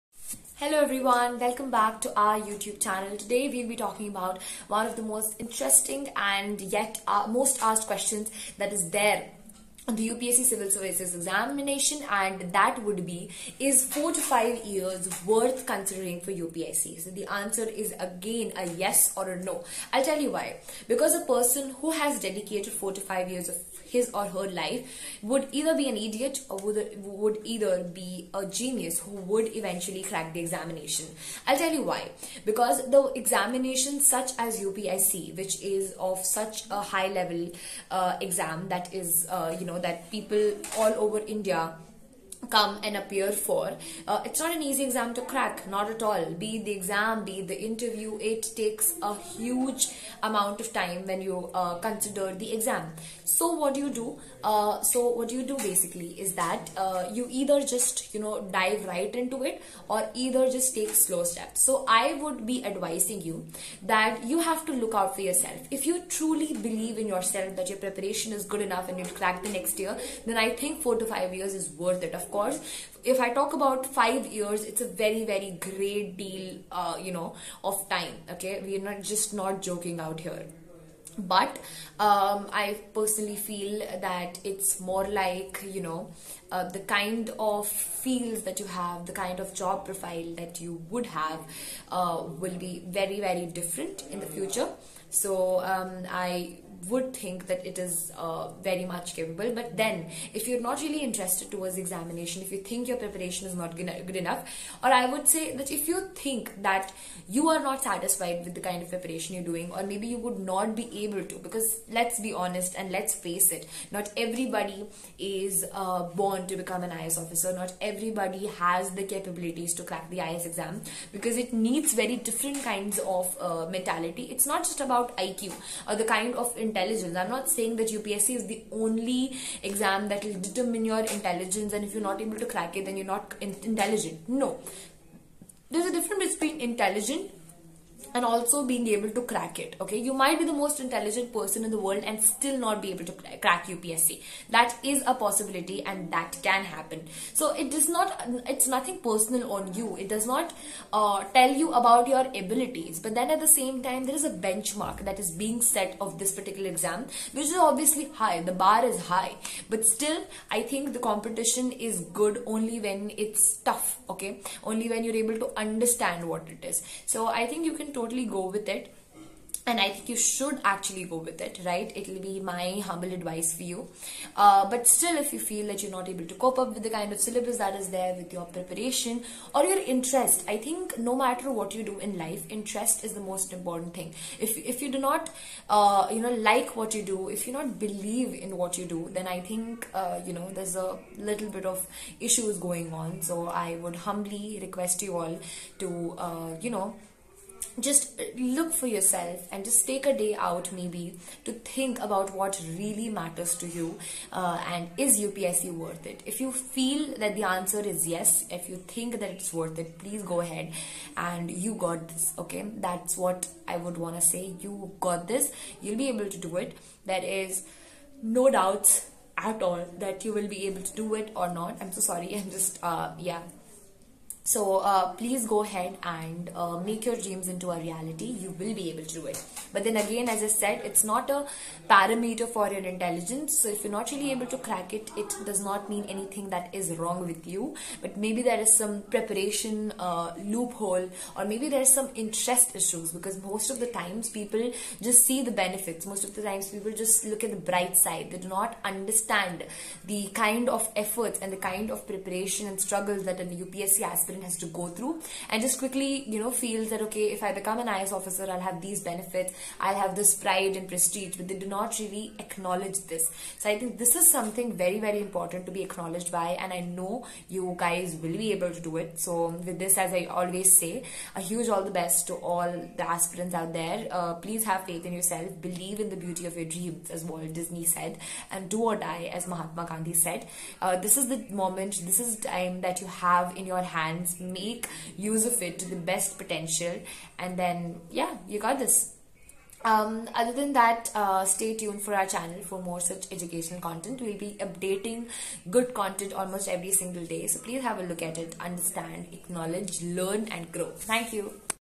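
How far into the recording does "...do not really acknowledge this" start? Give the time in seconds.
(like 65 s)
261 s.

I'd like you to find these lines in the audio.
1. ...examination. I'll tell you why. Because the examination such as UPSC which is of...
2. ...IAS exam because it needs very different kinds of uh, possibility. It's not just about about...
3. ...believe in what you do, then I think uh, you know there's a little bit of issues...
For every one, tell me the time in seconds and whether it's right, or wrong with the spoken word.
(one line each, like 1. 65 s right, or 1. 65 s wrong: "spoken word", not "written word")
1. 30 s right
2. 120 s wrong: "mentality", not "possibility"
3. 187 s right.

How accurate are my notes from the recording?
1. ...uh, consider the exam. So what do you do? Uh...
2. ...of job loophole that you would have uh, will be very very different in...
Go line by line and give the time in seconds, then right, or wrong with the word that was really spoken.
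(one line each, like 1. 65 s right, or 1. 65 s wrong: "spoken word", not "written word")
1. 51 s right
2. 89 s wrong: "profile", not "loophole".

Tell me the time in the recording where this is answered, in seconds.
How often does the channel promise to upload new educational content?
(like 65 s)
296 s.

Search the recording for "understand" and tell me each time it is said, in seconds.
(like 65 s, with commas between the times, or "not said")
165 s, 248 s, 298 s.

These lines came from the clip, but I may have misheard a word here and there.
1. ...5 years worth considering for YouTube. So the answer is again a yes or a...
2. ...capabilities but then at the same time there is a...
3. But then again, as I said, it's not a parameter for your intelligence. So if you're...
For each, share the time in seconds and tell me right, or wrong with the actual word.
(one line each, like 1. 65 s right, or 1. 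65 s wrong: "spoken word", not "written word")
1. 14 s wrong: "UPSC", not "YouTube"
2. 152 s wrong: "abilities", not "capabilities"
3. 229 s right.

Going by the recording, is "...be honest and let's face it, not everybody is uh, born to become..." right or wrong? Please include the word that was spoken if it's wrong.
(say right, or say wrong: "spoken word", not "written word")
right.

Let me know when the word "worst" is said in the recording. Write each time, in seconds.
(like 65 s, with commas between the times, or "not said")
not said.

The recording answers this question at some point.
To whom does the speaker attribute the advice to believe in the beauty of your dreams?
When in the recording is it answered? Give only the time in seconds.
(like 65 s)
277 s.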